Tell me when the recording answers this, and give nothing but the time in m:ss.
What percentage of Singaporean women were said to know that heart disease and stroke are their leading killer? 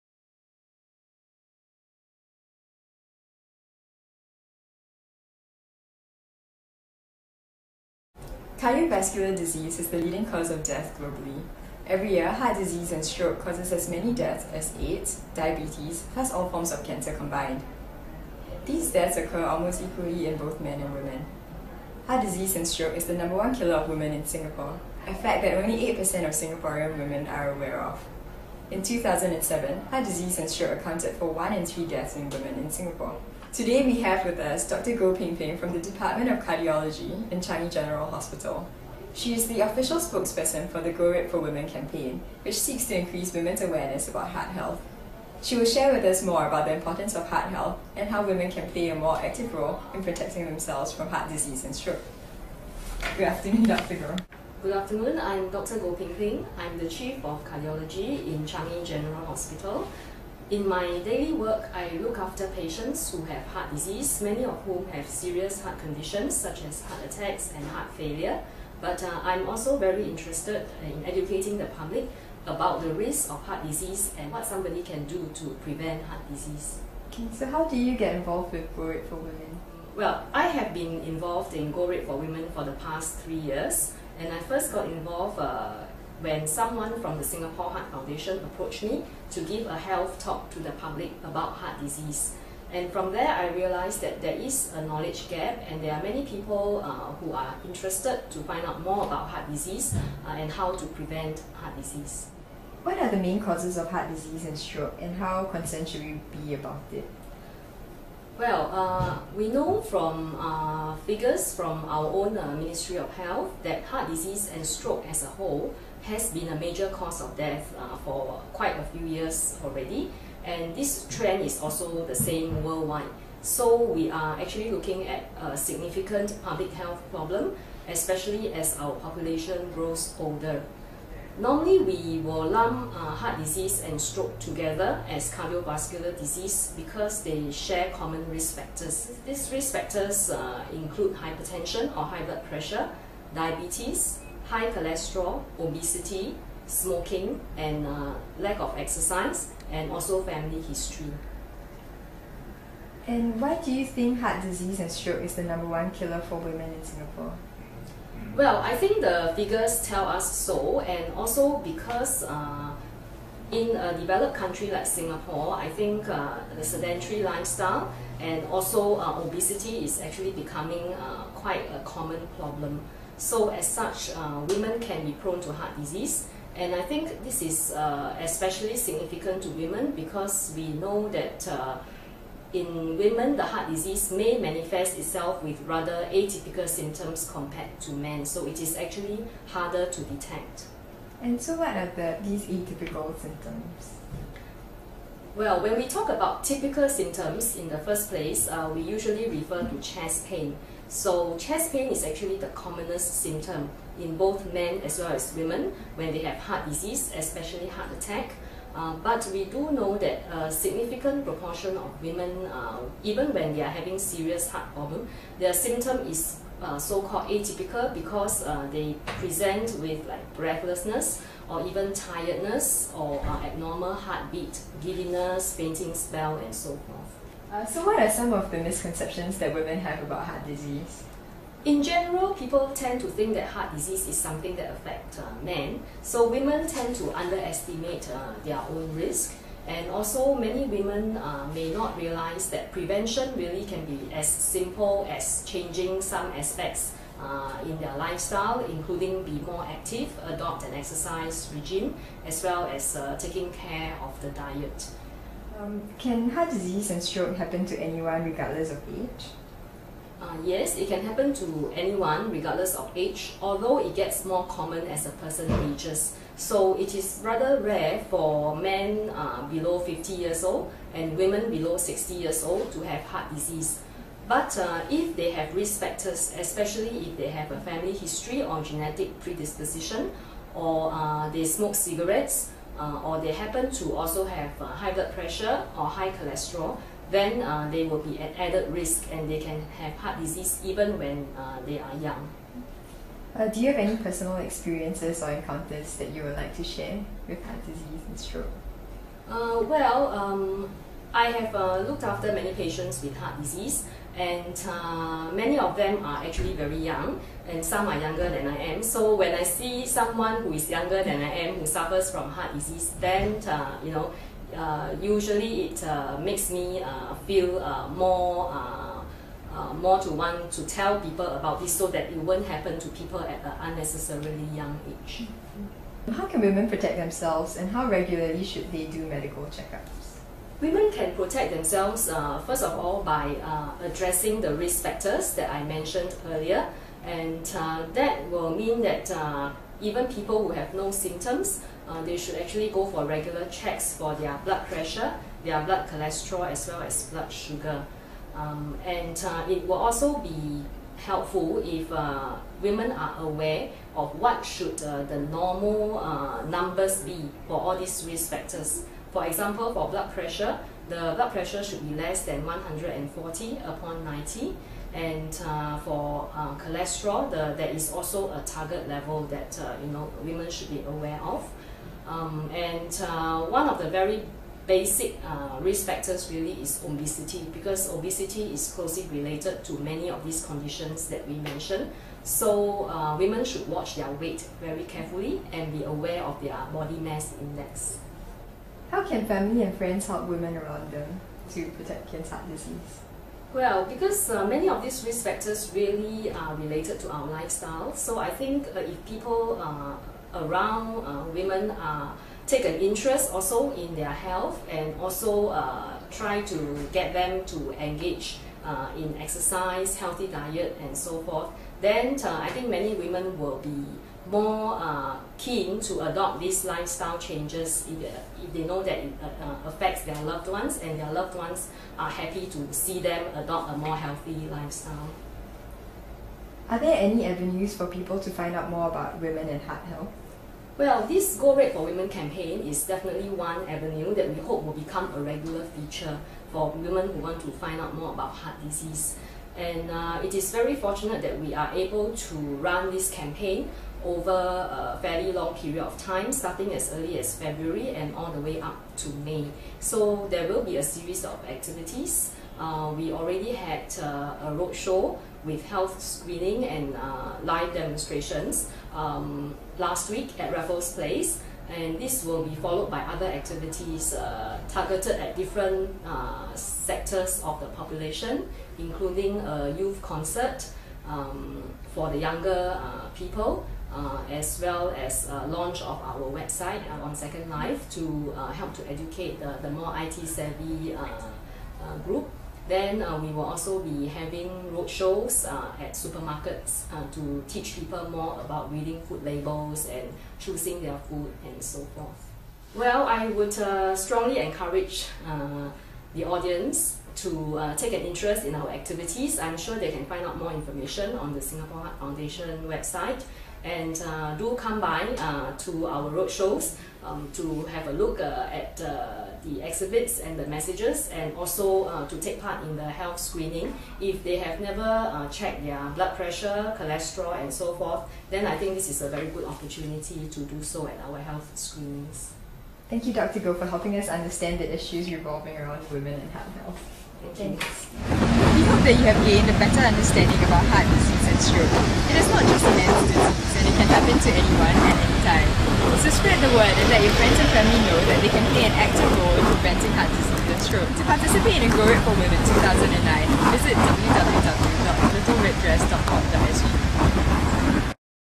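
0:25.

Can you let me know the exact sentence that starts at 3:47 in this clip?
Uh, so what are some of the misconceptions that women have about heart disease?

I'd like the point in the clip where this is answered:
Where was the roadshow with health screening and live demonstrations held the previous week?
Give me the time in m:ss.
7:40.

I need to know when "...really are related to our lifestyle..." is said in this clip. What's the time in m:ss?
6:35.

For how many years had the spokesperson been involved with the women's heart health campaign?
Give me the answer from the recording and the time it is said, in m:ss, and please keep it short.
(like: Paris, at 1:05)
3, at 1:23.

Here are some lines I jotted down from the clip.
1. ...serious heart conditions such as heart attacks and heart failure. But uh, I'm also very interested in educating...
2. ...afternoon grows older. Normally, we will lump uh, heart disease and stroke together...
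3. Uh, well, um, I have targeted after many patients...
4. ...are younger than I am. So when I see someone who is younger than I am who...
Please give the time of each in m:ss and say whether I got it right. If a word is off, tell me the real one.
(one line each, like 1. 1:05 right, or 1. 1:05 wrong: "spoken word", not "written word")
1. 1:05 right
2. 2:08 wrong: "population", not "afternoon"
3. 4:59 wrong: "looked", not "targeted"
4. 5:07 right.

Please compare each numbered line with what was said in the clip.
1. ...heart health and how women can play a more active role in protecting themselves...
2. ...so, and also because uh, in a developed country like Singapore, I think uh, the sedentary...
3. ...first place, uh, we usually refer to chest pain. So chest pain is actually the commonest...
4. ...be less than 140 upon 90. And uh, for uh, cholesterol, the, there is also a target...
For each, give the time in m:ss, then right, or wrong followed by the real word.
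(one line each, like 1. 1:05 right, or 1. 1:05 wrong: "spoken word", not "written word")
1. 0:47 right
2. 2:40 right
3. 3:17 right
4. 6:01 right.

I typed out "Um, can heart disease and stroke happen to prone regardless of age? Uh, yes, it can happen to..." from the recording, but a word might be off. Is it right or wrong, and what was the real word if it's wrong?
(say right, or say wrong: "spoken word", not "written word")
wrong: "anyone", not "prone".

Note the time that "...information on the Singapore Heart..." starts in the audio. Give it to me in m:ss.
8:20.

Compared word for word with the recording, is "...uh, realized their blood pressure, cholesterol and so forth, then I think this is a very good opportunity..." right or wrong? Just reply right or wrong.
wrong.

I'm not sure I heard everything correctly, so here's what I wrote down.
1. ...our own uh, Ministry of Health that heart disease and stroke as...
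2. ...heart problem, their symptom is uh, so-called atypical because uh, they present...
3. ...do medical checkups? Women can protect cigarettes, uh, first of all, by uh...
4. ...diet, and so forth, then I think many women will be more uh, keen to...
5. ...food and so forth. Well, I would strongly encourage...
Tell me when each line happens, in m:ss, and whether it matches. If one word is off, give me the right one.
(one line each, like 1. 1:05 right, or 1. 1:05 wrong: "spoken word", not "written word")
1. 1:51 right
2. 3:34 right
3. 5:28 wrong: "themselves", not "cigarettes"
4. 6:50 right
5. 8:10 right.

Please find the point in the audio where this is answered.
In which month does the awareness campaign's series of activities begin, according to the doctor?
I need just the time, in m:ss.
7:27.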